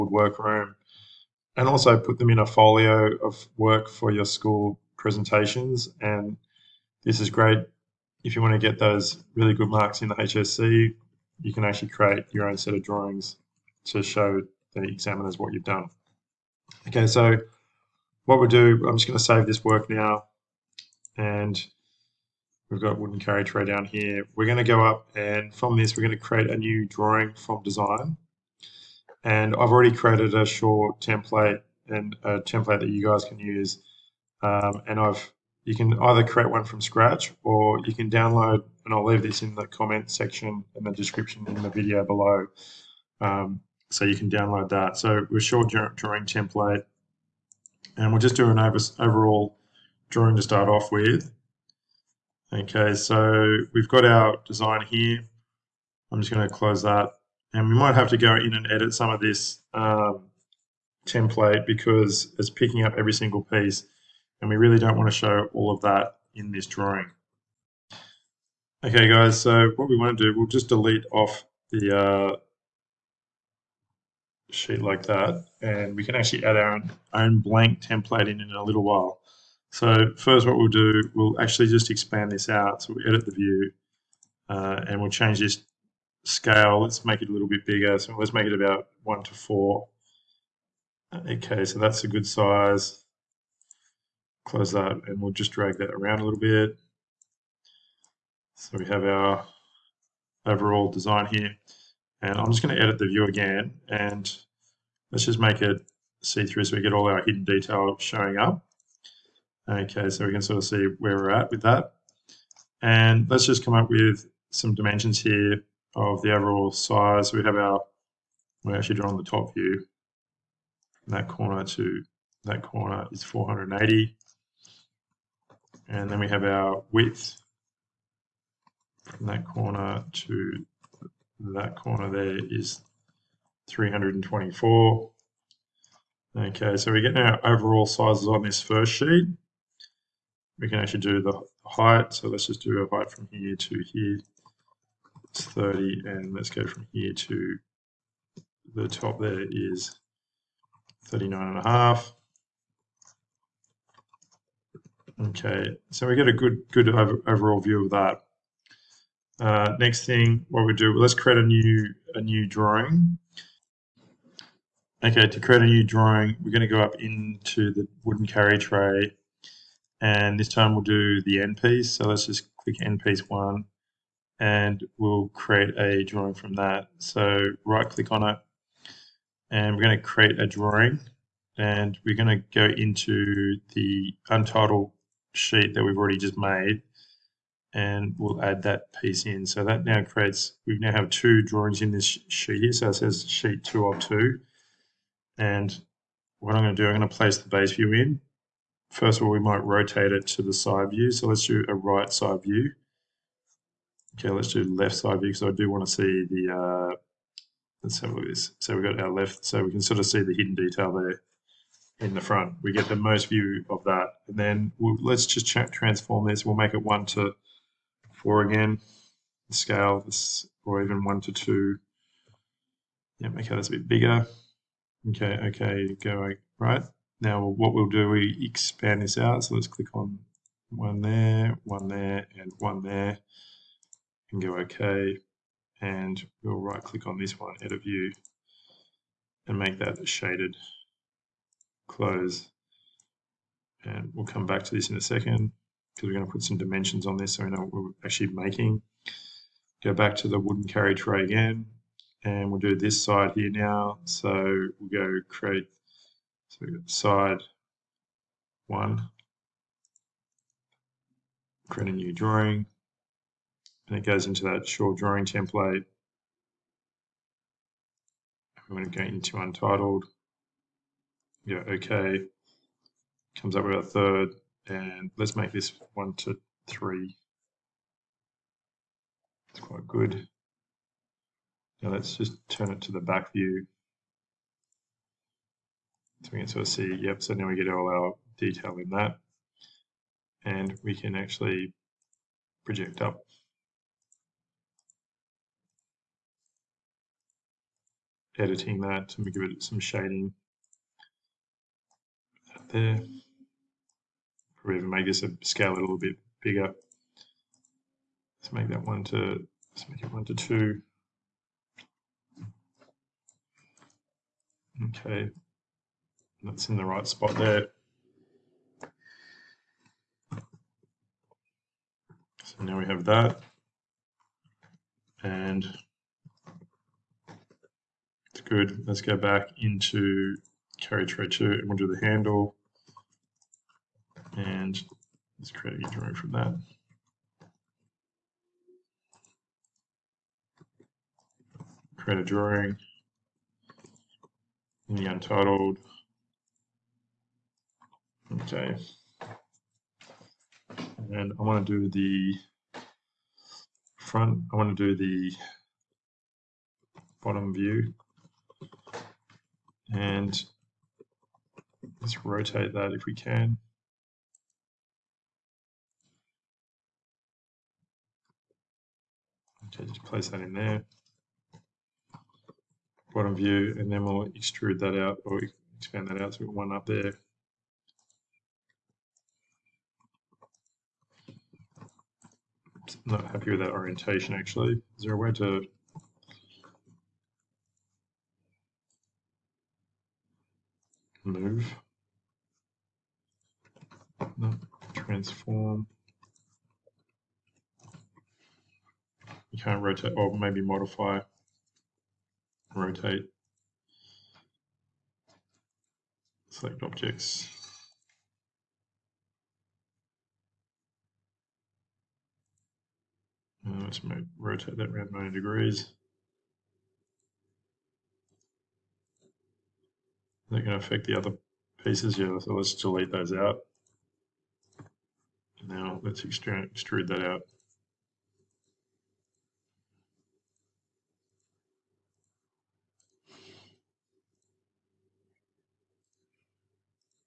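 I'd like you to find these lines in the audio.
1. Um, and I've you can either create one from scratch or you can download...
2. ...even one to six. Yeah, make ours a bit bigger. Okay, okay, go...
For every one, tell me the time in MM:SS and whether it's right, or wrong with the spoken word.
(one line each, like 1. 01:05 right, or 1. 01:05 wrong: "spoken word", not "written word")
1. 00:34 right
2. 03:40 wrong: "two", not "six".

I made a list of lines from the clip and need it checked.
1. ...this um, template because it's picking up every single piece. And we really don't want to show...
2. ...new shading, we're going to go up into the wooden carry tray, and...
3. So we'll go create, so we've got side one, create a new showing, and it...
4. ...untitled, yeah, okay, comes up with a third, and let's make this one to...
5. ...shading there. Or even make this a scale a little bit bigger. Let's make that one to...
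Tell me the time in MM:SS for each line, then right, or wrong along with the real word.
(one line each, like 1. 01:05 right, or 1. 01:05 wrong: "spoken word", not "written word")
1. 00:59 right
2. 02:45 wrong: "drawing", not "shading"
3. 04:14 wrong: "drawing", not "showing"
4. 04:29 right
5. 04:59 right.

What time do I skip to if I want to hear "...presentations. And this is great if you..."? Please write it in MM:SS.
00:04.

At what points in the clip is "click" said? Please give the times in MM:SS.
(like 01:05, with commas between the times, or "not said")
02:52, 02:57, 03:49, 03:56.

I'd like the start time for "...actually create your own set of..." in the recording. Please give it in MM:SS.
00:11.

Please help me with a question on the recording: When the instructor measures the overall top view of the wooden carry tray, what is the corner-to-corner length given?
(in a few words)
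480.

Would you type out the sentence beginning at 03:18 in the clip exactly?
First of all, we might rotate it to the side view.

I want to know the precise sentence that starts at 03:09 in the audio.
So that now creates, we now have two drawings in this sheet here.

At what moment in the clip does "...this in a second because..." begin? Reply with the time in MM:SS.
04:04.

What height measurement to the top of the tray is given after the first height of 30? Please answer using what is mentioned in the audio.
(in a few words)
39 and a half.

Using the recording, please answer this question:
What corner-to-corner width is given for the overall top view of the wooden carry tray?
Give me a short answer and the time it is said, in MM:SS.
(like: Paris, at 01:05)
324, at 02:13.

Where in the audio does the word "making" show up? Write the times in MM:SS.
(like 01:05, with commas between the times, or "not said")
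04:08.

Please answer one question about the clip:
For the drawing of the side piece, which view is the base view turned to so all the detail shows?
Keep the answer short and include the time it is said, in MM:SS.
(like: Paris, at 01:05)
back view, at 04:42.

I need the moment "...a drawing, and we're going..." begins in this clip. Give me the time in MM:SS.
03:00.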